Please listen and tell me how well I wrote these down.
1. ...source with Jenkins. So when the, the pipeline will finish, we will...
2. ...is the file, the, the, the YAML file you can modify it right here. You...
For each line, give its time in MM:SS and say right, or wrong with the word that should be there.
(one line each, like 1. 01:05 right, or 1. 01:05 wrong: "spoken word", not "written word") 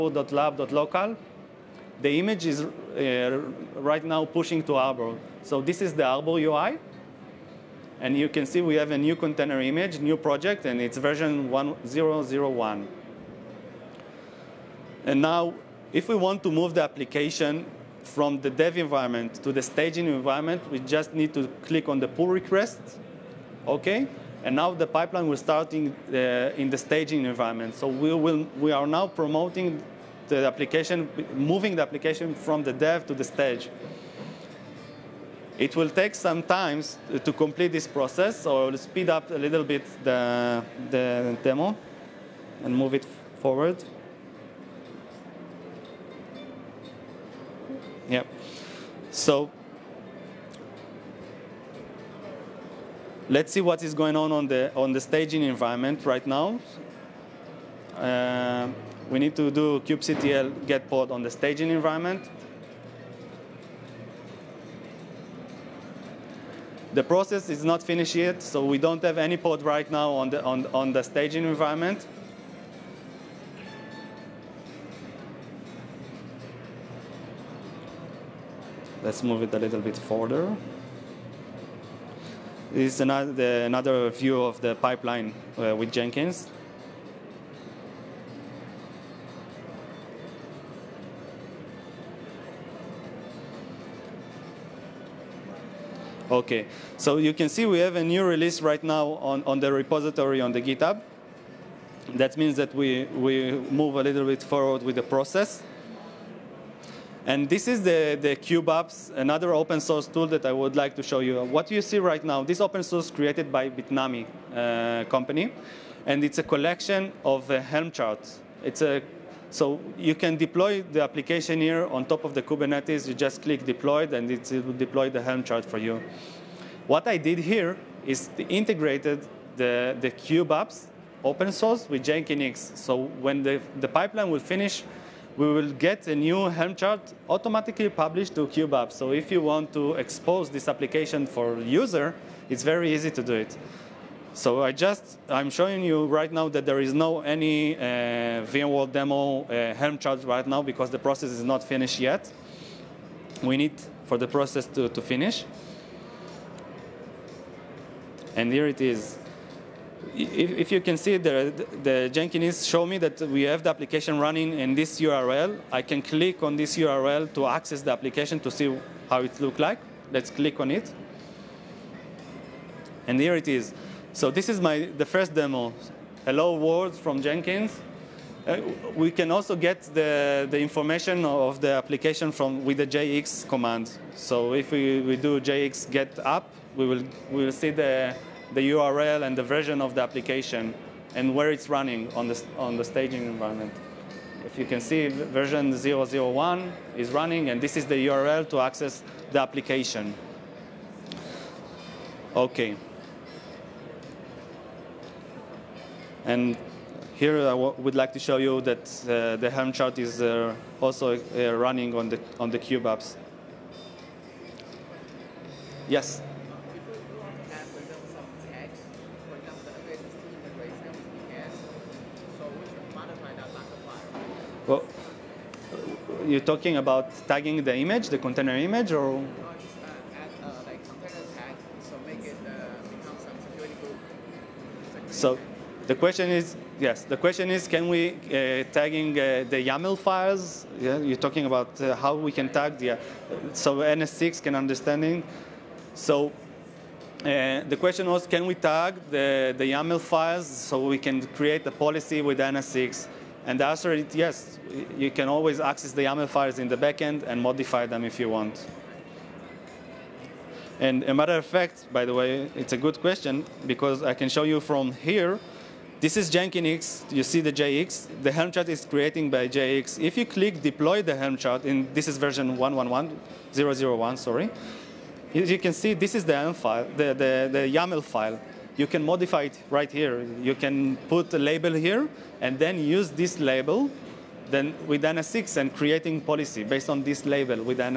1. 02:11 right
2. 04:36 right.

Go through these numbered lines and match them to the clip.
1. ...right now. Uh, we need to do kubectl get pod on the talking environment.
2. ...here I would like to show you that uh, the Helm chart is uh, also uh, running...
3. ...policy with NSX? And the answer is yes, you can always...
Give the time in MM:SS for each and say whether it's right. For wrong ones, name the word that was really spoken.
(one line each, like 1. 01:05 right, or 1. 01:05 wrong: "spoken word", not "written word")
1. 00:56 wrong: "staging", not "talking"
2. 03:27 right
3. 04:11 right.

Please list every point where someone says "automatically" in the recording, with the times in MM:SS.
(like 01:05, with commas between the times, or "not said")
02:17.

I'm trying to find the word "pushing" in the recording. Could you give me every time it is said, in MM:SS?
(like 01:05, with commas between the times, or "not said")
00:04.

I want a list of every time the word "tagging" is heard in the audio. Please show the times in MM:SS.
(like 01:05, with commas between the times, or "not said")
03:47, 03:58.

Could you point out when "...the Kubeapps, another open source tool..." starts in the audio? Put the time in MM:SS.
01:48.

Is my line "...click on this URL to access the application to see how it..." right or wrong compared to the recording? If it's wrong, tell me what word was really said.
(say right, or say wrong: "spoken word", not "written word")
right.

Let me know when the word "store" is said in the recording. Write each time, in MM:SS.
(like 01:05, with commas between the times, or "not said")
not said.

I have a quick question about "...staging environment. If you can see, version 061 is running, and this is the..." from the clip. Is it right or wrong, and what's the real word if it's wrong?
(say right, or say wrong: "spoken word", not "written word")
wrong: "001", not "061".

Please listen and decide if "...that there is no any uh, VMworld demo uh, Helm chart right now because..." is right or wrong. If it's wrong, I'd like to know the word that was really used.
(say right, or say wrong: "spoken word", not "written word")
right.